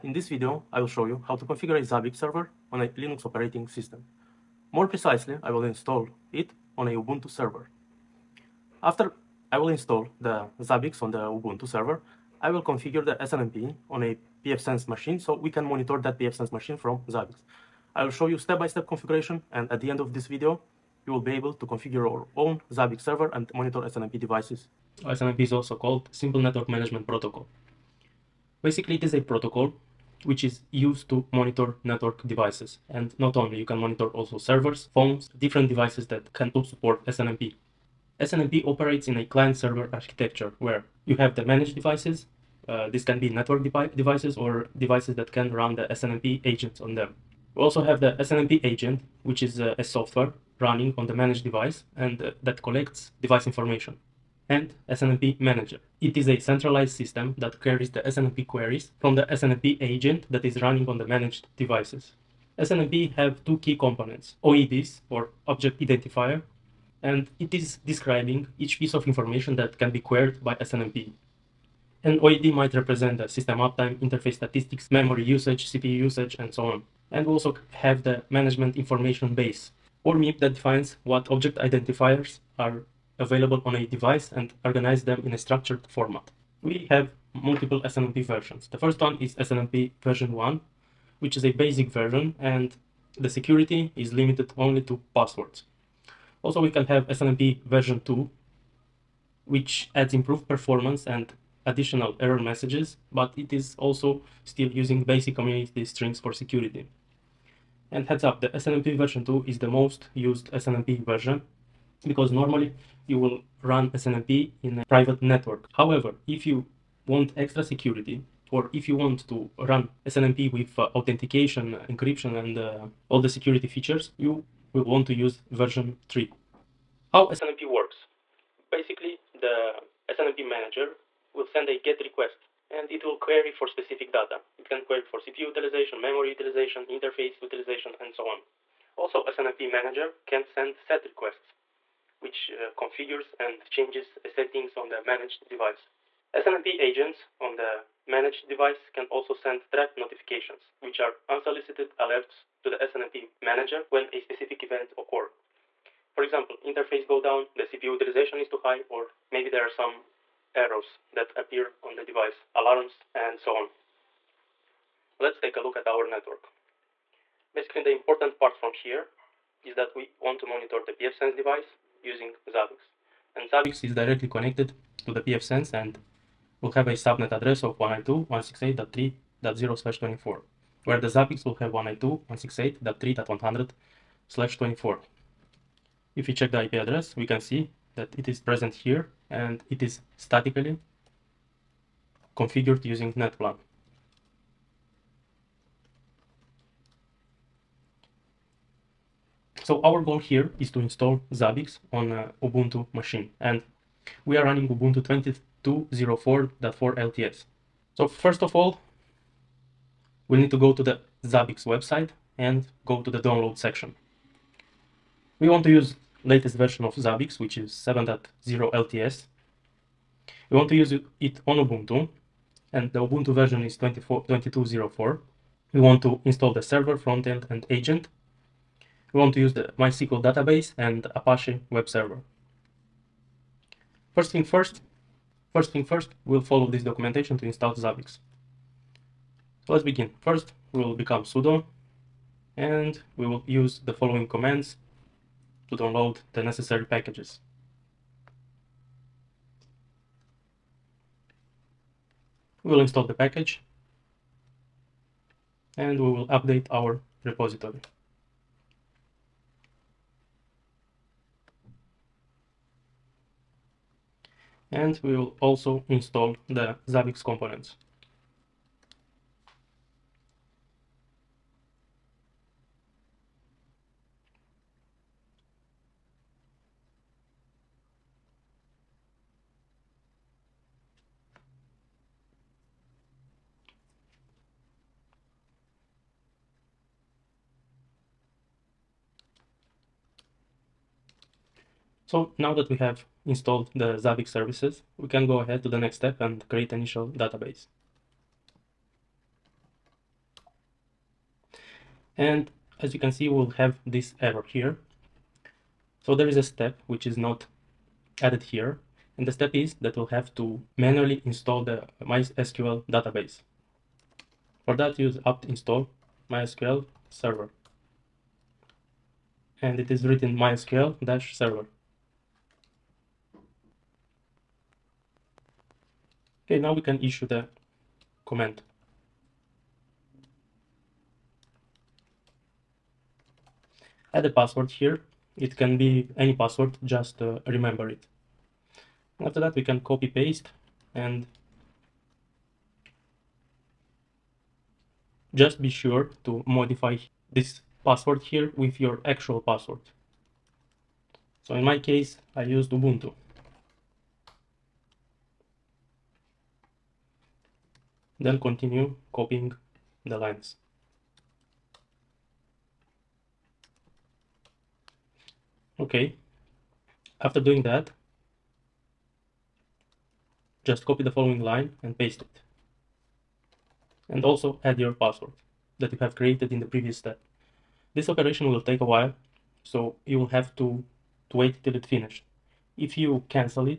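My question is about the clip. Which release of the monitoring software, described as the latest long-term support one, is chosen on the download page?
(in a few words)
7.0 LTS.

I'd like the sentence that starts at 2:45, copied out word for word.
Let's take a look at our network.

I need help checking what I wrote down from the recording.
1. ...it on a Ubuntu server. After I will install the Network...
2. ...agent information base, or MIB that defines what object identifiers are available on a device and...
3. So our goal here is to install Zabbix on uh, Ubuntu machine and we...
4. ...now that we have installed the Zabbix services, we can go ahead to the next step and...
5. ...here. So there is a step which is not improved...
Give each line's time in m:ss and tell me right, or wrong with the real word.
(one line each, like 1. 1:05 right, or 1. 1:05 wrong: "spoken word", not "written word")
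1. 0:06 wrong: "Zabbix", not "Network"
2. 1:18 wrong: "management", not "agent"
3. 3:19 right
4. 4:52 right
5. 5:04 wrong: "added", not "improved".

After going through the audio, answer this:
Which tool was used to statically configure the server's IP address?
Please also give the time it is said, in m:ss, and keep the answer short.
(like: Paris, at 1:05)
netplan, at 3:13.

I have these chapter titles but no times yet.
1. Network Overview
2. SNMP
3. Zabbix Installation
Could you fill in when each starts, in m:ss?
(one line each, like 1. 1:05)
1. 2:44
2. 0:21
3. 3:29.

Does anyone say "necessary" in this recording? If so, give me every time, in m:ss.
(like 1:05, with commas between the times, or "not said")
4:06.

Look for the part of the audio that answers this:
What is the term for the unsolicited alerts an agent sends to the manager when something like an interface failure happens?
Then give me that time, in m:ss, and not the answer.
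2:29.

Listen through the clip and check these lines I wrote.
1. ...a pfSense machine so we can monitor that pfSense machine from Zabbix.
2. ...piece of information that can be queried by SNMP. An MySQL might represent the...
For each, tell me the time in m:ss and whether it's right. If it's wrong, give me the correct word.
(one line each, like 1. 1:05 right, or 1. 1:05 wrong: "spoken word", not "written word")
1. 0:14 right
2. 1:08 wrong: "OID", not "MySQL".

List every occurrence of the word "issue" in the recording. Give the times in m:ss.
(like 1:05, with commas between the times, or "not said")
5:27.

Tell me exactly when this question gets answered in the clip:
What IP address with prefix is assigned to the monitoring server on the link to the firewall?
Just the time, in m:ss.
3:01.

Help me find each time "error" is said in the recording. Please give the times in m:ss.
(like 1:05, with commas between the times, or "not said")
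1:42, 2:40, 5:04.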